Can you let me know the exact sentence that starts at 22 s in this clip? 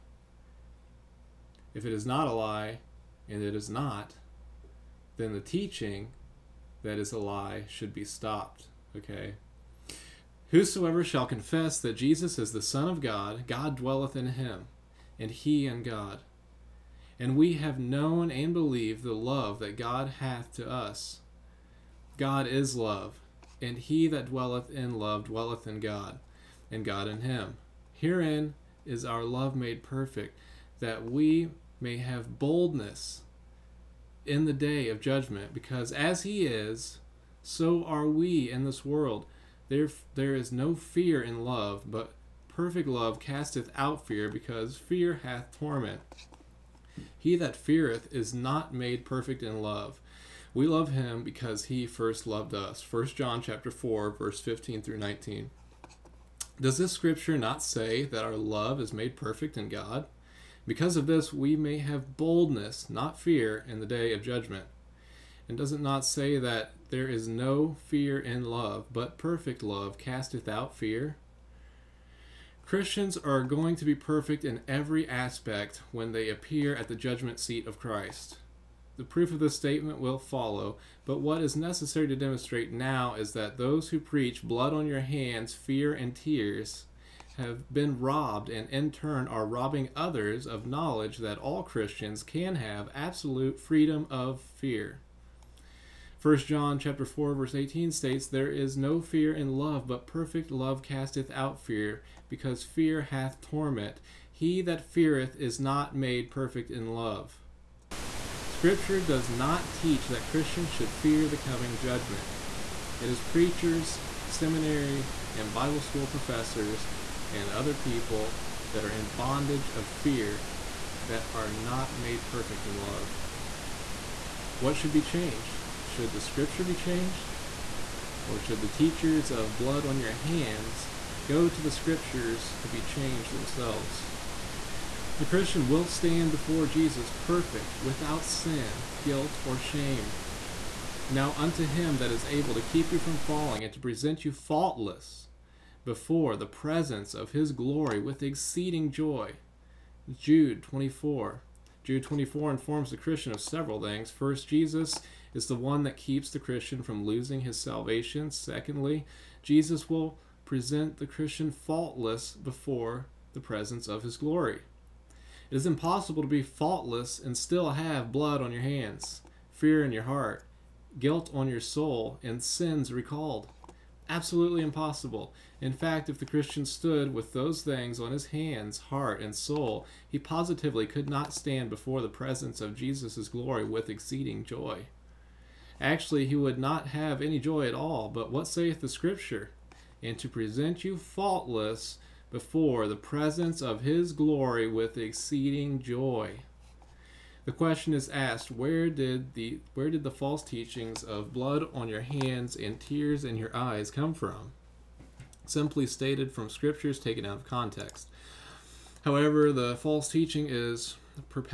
God is love, and he that dwelleth in love dwelleth in God, and God in him.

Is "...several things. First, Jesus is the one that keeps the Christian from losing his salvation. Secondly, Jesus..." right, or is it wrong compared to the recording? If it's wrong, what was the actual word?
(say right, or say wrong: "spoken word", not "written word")
right.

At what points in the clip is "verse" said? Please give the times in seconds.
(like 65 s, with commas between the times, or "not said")
54 s, 97 s.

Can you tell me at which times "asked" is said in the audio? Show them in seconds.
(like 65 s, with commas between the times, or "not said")
198 s.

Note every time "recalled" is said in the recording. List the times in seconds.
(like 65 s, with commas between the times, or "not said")
172 s.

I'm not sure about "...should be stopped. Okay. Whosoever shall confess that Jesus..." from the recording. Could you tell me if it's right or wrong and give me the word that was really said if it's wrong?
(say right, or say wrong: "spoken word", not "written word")
right.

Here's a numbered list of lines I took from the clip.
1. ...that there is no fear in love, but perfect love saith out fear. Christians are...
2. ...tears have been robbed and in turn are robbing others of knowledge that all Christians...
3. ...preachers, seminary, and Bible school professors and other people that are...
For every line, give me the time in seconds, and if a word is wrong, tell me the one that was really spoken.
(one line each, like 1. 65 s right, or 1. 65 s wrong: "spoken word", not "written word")
1. 66 s wrong: "casteth", not "saith"
2. 86 s right
3. 113 s right.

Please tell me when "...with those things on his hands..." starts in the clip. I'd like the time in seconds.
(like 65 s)
177 s.